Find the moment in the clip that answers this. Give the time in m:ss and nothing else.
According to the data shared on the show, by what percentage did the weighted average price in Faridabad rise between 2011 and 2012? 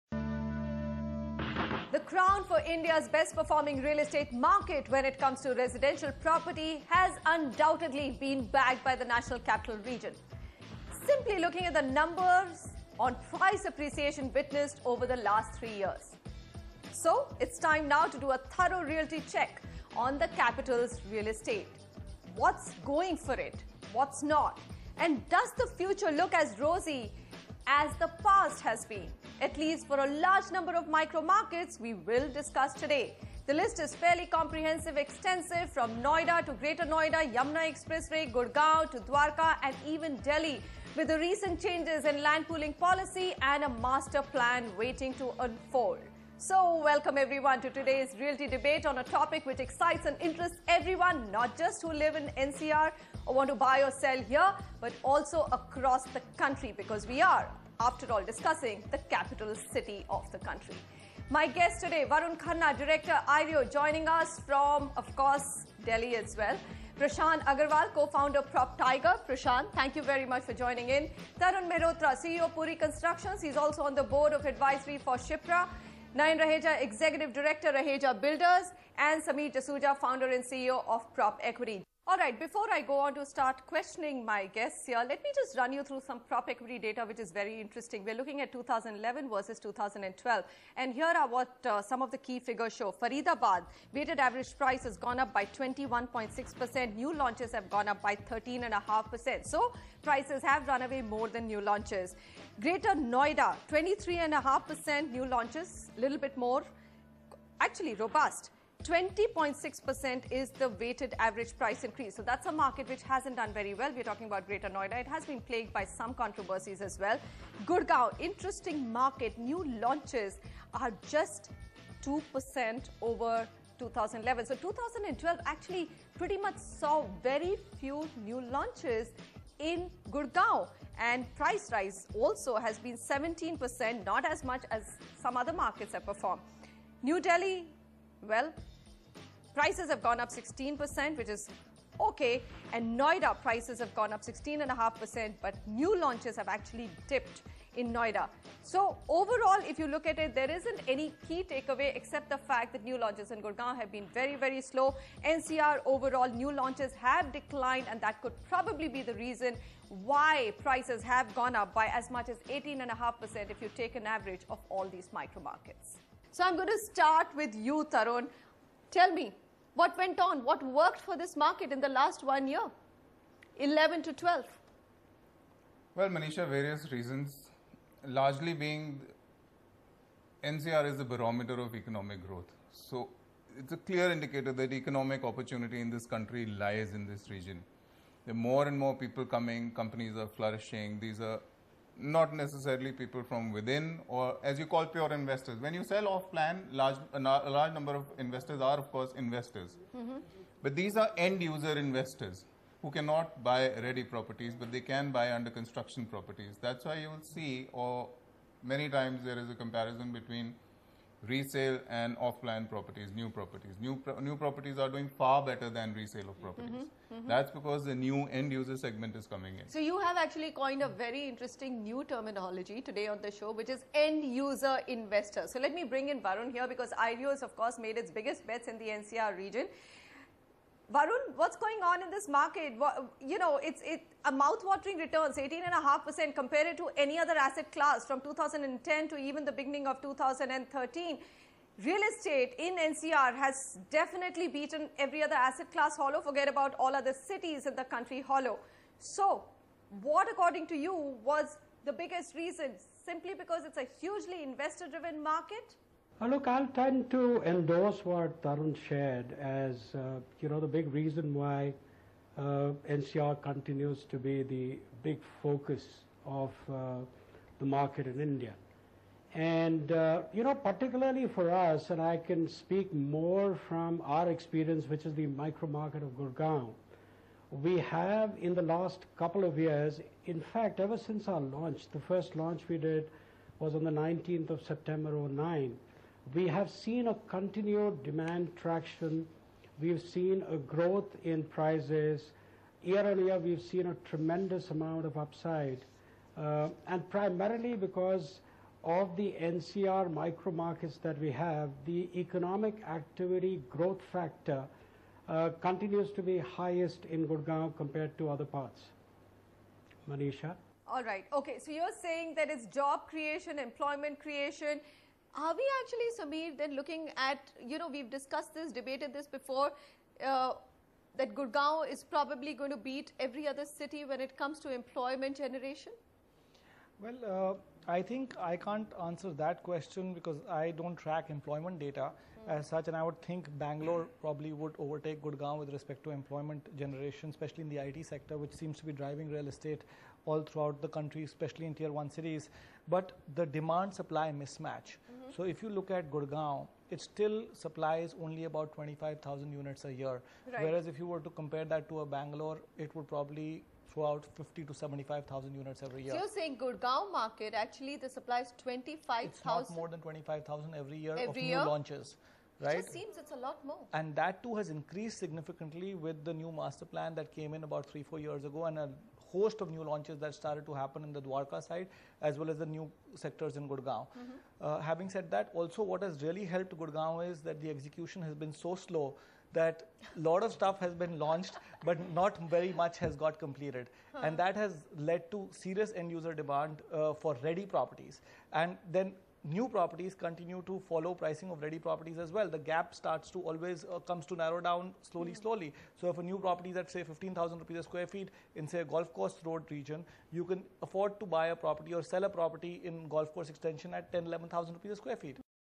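1:35.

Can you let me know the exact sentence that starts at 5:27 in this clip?
Well, uh, I think I can't answer that question because I don't track employment data mm.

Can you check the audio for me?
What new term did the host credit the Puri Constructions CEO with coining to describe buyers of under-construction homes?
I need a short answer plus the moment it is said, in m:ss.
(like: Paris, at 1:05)
end user investor, at 3:43.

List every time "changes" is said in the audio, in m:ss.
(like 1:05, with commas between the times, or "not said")
0:41.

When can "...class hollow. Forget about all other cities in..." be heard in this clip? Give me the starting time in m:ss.
4:05.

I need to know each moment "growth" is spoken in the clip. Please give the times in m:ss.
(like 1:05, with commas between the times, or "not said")
3:02, 4:50, 5:03.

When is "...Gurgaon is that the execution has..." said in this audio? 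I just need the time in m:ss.
6:16.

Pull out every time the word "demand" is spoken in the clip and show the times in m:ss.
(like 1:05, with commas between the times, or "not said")
4:48, 5:43, 6:26.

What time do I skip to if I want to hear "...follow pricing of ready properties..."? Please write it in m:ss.
6:30.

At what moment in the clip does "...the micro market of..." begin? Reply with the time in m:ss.
4:35.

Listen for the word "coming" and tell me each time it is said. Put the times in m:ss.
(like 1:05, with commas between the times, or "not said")
3:09, 3:39.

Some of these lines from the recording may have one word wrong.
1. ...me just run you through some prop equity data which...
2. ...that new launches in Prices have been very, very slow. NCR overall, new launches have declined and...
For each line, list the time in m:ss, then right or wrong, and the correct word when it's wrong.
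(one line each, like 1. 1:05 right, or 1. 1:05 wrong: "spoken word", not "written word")
1. 1:25 right
2. 2:32 wrong: "Gurgaon", not "Prices".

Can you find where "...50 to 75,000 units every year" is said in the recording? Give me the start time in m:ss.
5:54.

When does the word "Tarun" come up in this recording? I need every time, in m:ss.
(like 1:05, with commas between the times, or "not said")
1:11, 2:47, 4:18.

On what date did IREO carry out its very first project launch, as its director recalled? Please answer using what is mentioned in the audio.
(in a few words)
19 September 2009.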